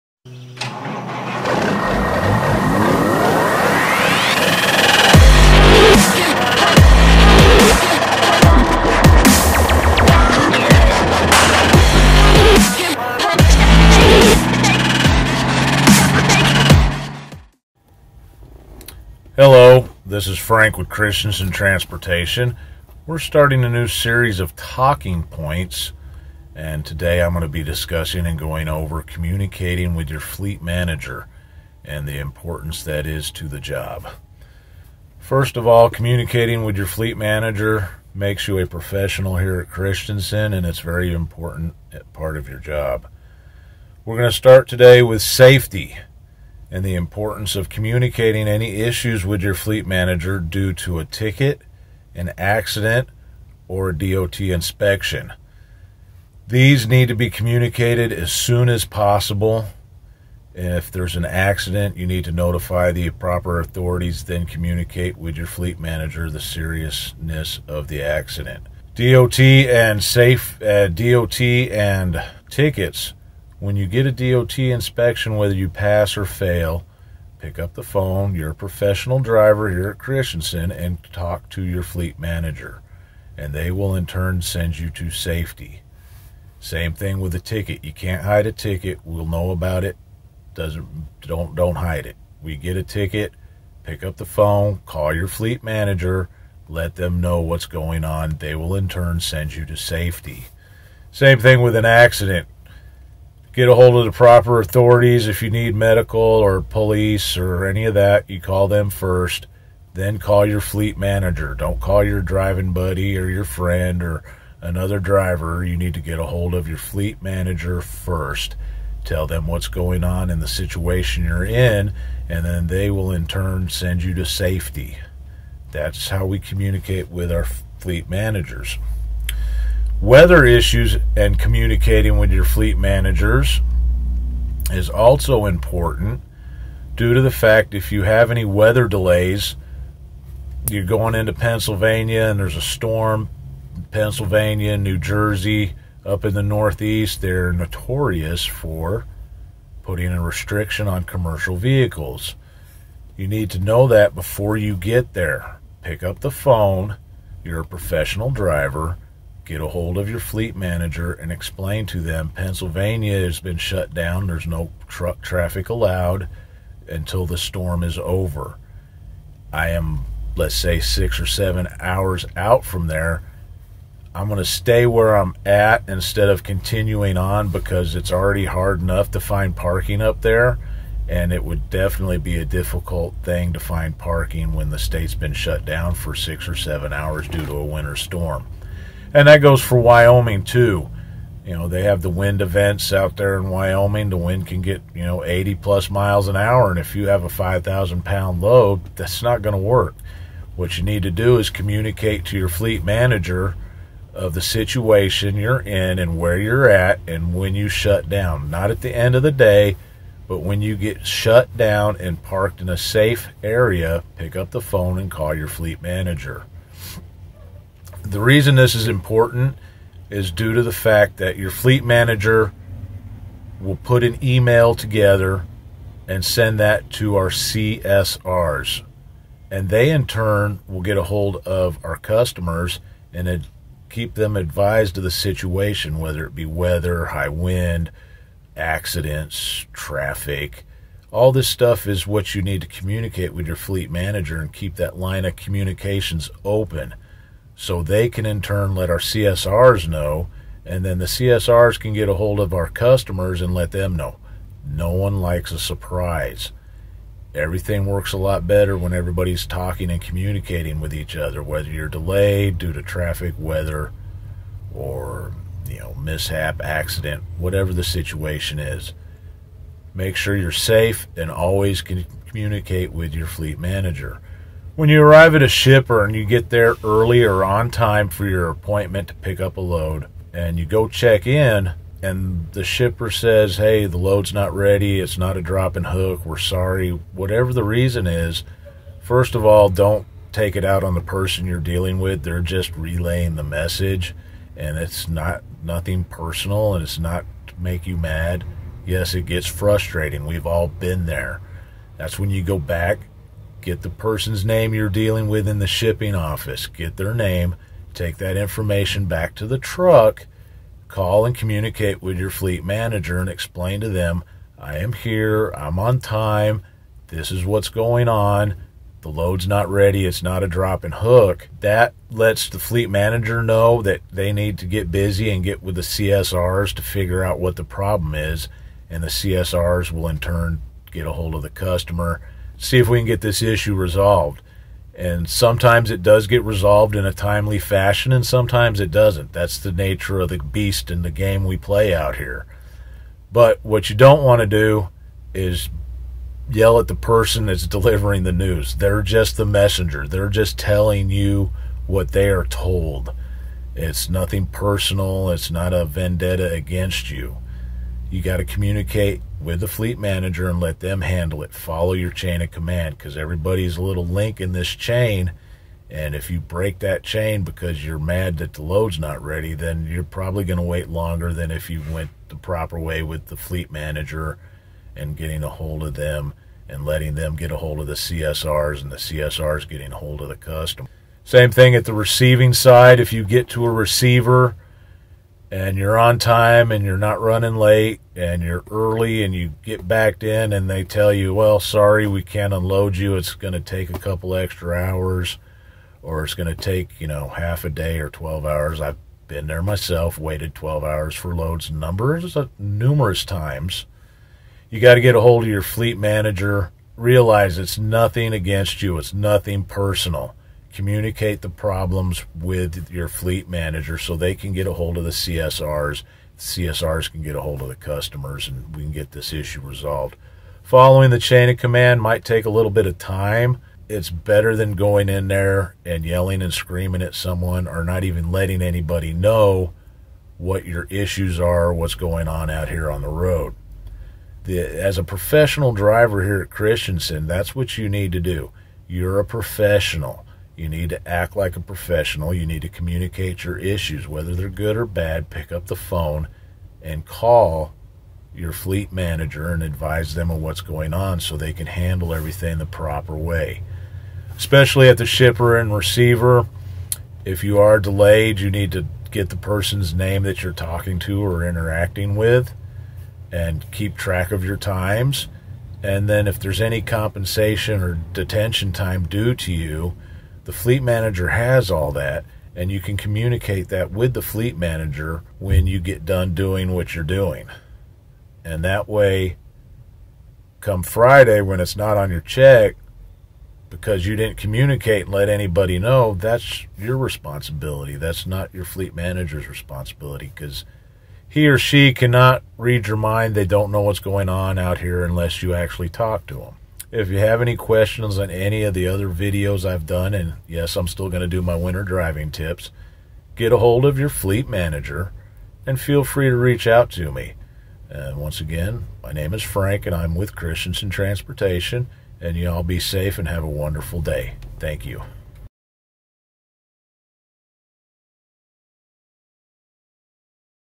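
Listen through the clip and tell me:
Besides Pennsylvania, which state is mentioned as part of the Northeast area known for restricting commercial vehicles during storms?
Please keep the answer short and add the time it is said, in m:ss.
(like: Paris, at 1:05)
New Jersey, at 2:24.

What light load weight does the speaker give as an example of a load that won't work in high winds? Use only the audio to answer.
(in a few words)
5,000 pounds.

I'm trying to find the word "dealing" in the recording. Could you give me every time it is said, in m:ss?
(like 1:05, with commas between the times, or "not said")
4:51, 5:04.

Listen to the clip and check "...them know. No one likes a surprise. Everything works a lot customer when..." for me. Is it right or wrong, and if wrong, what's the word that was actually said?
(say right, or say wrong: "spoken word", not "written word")
wrong: "better", not "customer".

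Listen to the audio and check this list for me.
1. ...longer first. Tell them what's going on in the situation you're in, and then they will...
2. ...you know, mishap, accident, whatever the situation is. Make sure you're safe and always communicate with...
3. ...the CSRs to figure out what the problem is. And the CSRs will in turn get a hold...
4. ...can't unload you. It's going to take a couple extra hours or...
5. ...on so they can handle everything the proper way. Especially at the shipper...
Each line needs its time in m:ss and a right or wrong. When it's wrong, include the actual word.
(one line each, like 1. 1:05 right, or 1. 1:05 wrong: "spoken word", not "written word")
1. 1:57 wrong: "manager", not "longer"
2. 4:25 right
3. 5:25 right
4. 6:32 right
5. 7:30 right.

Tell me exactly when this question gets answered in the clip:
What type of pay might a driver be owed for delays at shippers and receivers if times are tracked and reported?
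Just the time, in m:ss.
7:48.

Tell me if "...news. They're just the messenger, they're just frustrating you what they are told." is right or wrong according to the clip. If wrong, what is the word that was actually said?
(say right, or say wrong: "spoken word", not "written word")
wrong: "telling", not "frustrating".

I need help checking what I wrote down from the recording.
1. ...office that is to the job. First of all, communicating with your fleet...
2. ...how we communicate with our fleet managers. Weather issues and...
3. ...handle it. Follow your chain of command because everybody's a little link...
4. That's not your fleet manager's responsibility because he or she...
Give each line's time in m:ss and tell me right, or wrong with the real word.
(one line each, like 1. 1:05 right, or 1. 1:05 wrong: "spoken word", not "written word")
1. 0:32 wrong: "importance", not "office"
2. 2:06 right
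3. 6:01 right
4. 8:07 right.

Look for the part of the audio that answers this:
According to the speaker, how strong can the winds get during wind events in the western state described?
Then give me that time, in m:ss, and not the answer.
3:15.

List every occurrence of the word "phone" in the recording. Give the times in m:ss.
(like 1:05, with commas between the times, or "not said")
1:17, 1:34, 2:36, 3:34, 7:25.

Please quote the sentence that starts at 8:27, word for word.
And once again, my name is Frank and I'm with Christenson Transportation, and y'all be safe and have a wonderful day.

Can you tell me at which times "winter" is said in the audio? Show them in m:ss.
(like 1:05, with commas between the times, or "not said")
3:07, 8:21.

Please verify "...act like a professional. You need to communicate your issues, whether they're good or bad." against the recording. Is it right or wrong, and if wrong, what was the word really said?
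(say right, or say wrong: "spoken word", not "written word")
right.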